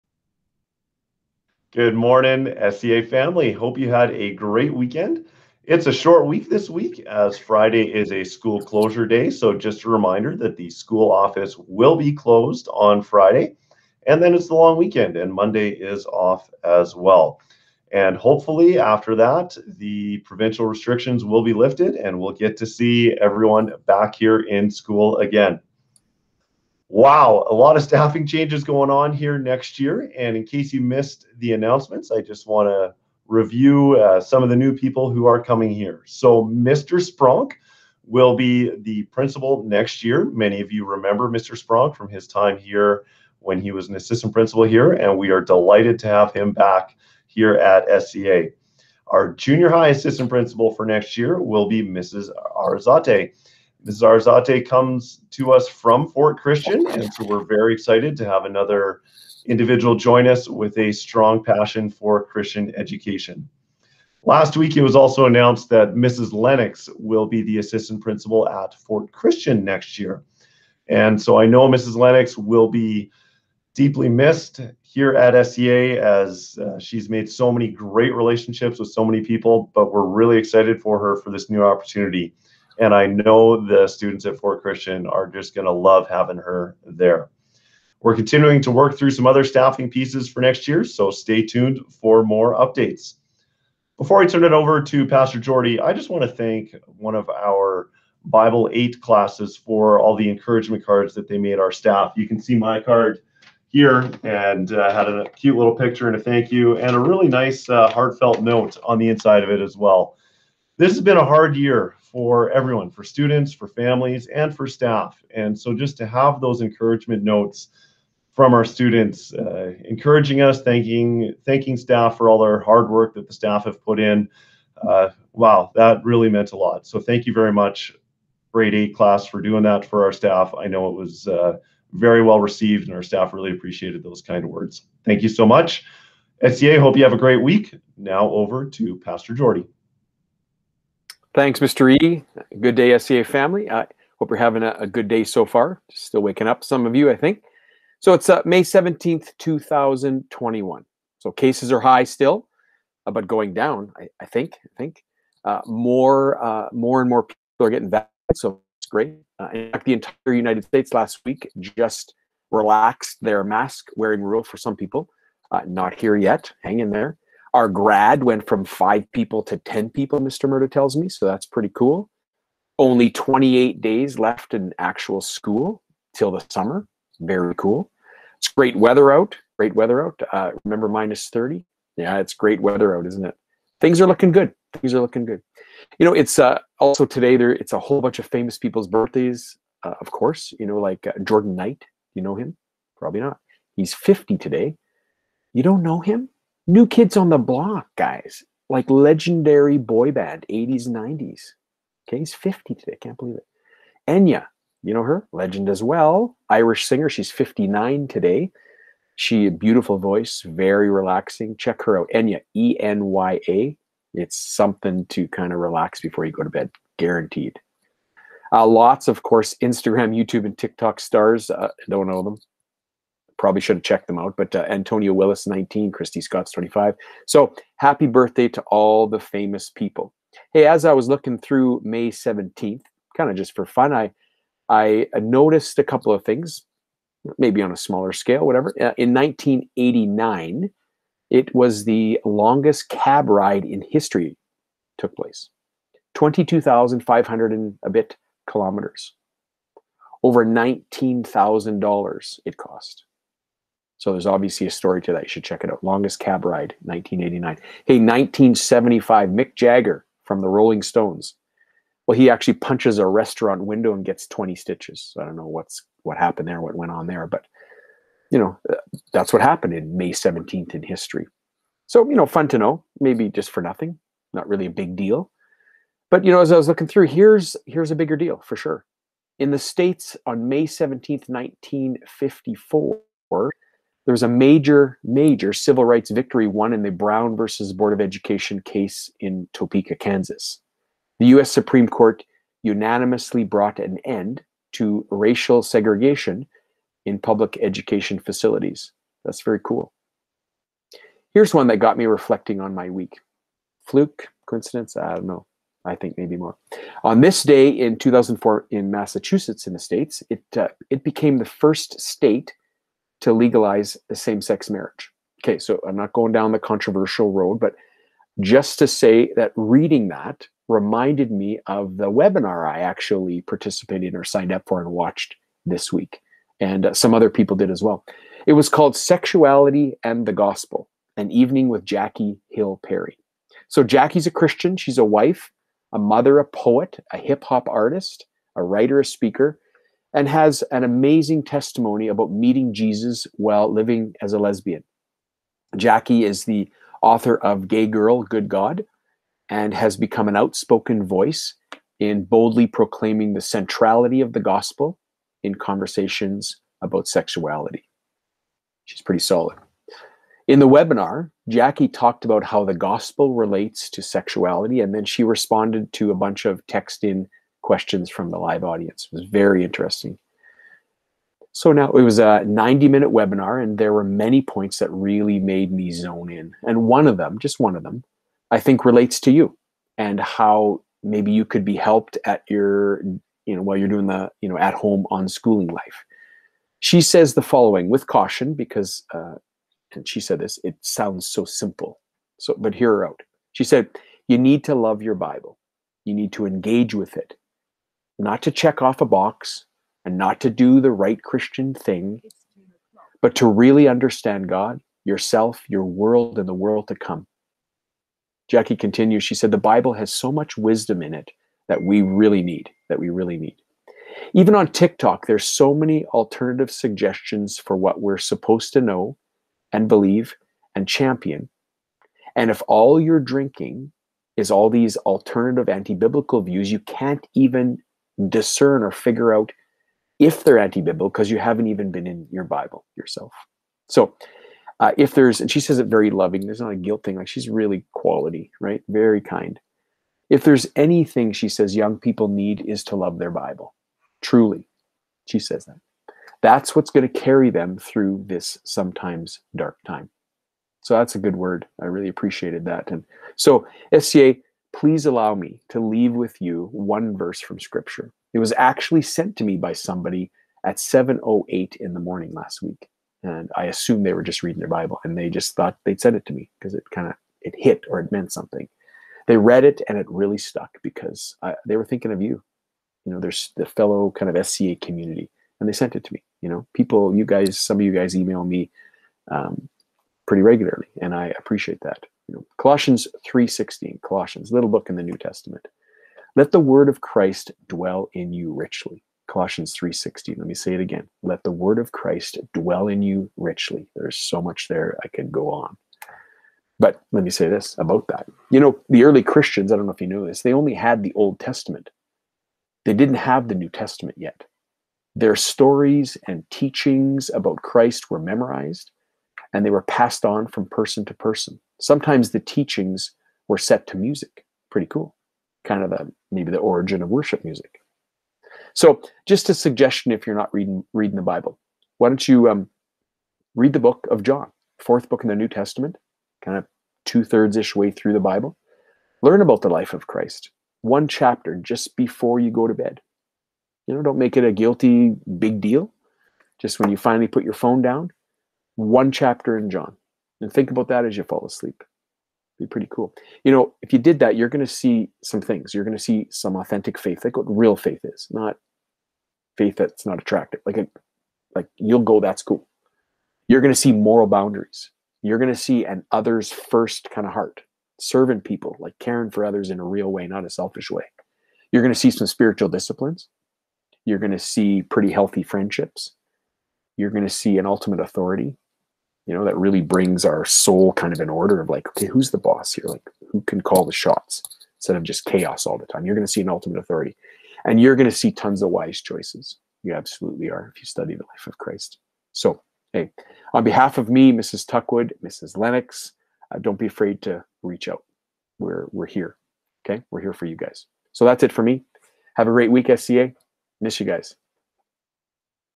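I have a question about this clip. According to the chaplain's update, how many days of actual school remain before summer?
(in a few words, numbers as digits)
28.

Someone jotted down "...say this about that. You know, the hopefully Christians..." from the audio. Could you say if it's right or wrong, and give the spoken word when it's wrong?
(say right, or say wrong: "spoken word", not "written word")
wrong: "early", not "hopefully".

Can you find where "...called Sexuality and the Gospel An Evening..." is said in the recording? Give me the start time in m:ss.
5:28.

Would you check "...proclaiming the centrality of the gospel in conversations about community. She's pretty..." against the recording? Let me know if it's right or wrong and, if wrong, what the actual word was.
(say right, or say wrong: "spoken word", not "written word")
wrong: "sexuality", not "community".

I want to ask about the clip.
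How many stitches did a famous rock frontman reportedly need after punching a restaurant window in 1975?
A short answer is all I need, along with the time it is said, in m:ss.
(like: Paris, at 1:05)
20, at 4:24.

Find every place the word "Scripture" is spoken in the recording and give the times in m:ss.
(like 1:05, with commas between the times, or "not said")
7:37.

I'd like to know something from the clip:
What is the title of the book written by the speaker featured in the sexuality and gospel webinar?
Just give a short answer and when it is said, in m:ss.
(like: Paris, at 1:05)
Gay Girl, Good God, at 5:47.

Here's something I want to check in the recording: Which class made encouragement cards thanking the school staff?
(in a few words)
Bible 8.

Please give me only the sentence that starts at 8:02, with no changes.
You know, Colossians 3.16, Colossians, little book in the New Testament.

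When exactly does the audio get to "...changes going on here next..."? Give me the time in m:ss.
0:28.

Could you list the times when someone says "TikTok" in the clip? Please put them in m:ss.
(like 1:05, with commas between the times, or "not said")
3:40, 6:54.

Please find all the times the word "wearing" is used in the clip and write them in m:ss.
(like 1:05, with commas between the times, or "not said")
2:43.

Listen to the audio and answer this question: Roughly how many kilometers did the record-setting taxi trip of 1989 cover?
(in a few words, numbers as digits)
22,500.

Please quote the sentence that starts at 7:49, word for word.
They read it and it really stuck because I, they were thinking of you.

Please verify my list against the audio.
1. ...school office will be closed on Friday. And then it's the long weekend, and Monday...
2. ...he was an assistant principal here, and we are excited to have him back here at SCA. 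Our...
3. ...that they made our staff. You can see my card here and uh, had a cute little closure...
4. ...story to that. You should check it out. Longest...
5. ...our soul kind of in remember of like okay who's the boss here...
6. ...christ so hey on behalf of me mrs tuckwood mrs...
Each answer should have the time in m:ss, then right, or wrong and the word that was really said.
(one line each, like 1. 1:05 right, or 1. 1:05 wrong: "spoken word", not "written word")
1. 0:10 right
2. 0:43 wrong: "delighted", not "excited"
3. 1:41 wrong: "picture", not "closure"
4. 4:14 right
5. 9:30 wrong: "order", not "remember"
6. 9:41 right.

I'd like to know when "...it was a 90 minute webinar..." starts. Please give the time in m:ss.
6:11.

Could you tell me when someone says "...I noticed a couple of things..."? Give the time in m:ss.
3:54.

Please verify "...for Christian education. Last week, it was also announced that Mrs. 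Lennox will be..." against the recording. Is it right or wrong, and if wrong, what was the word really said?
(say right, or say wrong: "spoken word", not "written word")
right.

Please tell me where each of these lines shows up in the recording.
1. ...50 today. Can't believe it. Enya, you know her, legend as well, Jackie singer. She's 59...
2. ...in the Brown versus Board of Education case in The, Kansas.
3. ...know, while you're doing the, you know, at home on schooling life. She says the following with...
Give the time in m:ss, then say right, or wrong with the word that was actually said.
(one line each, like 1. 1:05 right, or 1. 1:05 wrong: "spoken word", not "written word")
1. 3:22 wrong: "Irish", not "Jackie"
2. 4:46 wrong: "Topeka", not "The"
3. 6:23 right.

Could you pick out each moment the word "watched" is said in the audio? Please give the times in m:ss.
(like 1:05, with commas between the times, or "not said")
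5:24.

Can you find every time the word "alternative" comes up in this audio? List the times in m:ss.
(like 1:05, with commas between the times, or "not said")
6:56, 7:04.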